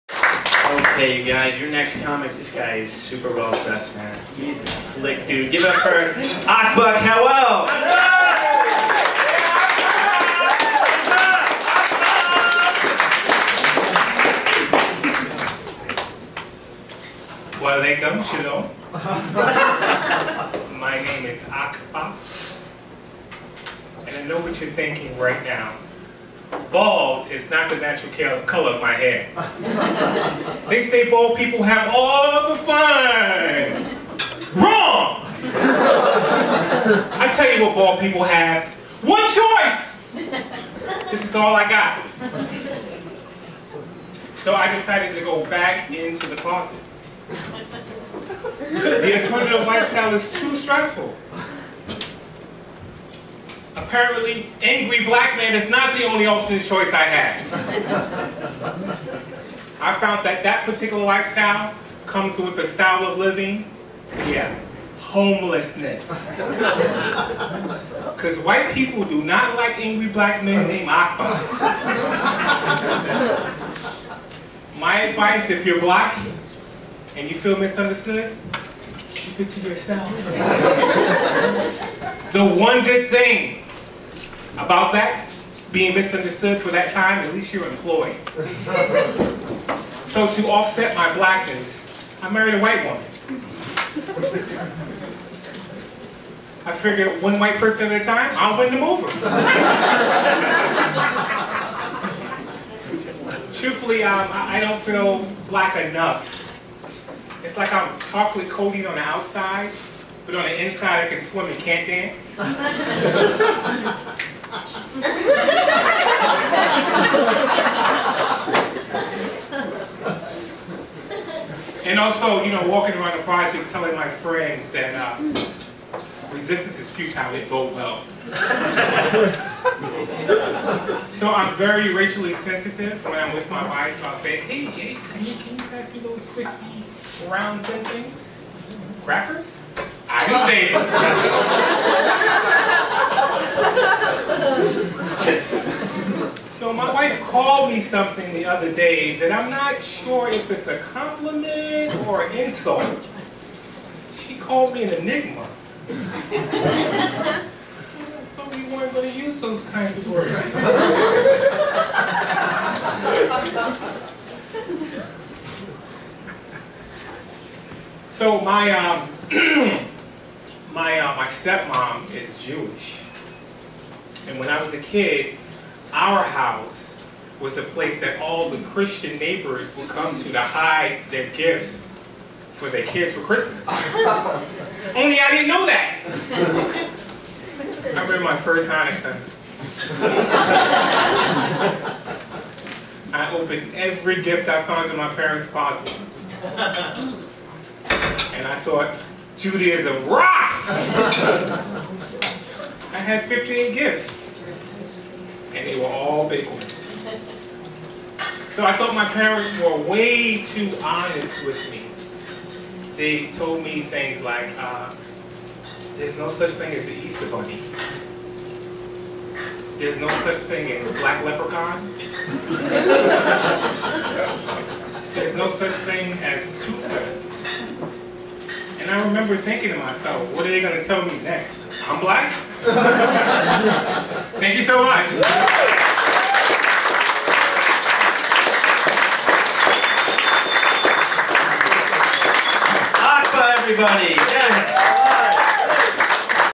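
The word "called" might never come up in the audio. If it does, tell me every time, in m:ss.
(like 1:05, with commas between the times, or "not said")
2:27, 2:34.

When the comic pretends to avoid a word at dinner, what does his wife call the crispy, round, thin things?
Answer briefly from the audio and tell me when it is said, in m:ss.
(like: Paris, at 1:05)
Crackers, at 2:19.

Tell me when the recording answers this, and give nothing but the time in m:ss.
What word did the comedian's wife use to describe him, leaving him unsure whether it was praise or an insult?
2:34.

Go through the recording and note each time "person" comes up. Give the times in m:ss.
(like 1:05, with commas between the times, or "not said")
1:37.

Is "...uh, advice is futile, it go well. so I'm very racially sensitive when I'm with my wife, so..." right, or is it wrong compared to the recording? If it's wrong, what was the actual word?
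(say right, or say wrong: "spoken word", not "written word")
wrong: "resistance", not "advice".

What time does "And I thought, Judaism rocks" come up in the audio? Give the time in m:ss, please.
3:18.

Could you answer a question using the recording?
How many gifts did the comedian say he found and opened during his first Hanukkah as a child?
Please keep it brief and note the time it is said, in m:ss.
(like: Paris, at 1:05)
15, at 3:23.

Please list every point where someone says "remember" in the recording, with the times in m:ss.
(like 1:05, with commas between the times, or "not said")
3:08, 3:49.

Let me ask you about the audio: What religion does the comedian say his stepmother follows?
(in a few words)
Jewish.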